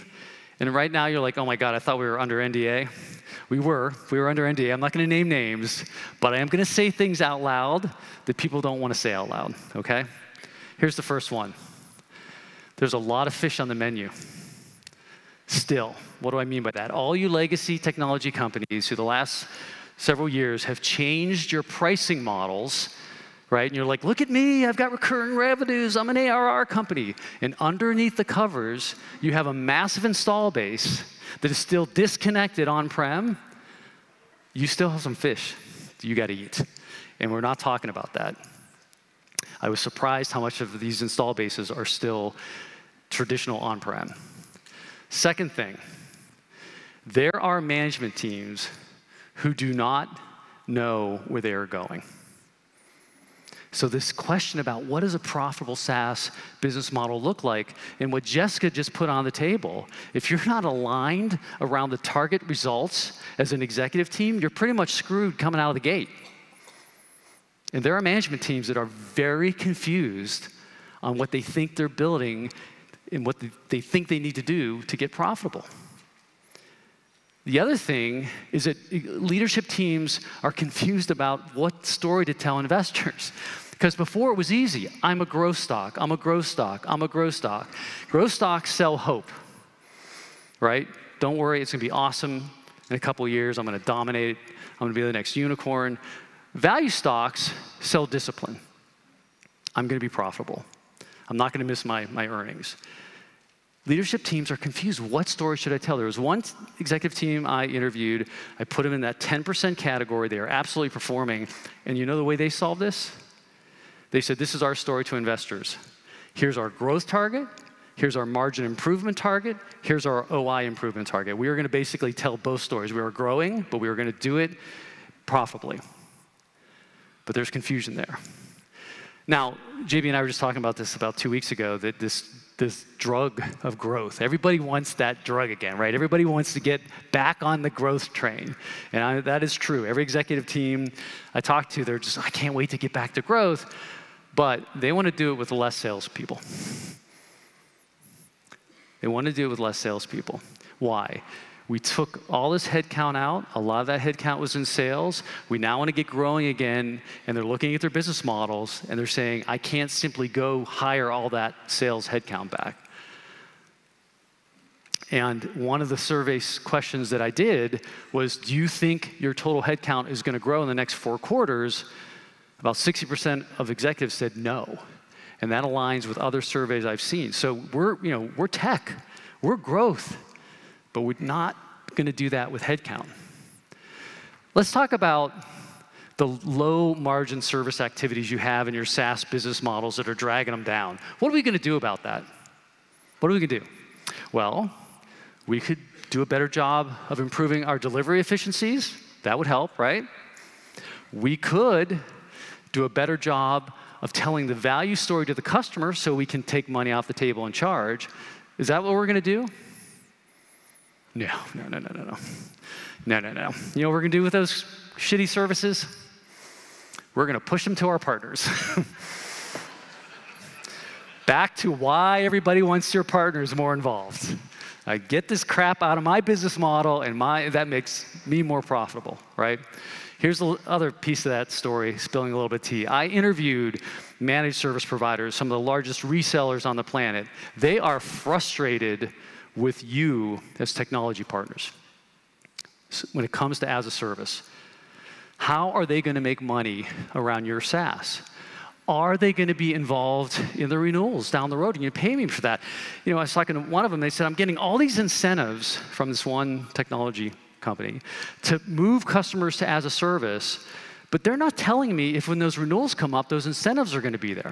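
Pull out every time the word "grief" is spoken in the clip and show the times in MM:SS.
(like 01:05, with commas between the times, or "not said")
not said.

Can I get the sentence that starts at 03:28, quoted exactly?
Is that what we're going to do?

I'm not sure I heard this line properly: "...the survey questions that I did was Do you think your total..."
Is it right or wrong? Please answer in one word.
right.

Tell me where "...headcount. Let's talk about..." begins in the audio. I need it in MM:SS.
03:02.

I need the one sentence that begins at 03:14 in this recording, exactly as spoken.
Well, we could do a better job of improving our delivery efficiencies.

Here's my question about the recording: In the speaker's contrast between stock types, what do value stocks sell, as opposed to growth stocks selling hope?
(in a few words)
Discipline.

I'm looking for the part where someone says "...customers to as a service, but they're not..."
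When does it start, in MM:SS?
04:19.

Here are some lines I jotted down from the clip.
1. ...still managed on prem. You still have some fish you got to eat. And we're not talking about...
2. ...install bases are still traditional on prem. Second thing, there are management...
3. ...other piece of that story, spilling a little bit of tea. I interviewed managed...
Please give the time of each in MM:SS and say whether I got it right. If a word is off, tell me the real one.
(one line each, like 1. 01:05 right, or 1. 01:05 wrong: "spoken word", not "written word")
1. 00:31 wrong: "disconnected", not "managed"
2. 00:41 right
3. 03:50 right.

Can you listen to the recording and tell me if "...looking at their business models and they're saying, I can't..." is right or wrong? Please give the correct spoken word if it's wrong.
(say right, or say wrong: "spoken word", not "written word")
right.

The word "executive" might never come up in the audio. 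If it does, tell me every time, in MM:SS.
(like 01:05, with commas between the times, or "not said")
01:03, 01:46, 02:20, 02:53.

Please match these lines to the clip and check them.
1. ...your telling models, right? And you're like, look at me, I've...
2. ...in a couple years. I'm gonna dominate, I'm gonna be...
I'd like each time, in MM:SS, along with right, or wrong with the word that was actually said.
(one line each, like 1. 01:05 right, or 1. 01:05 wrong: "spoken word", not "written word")
1. 00:21 wrong: "pricing", not "telling"
2. 01:32 right.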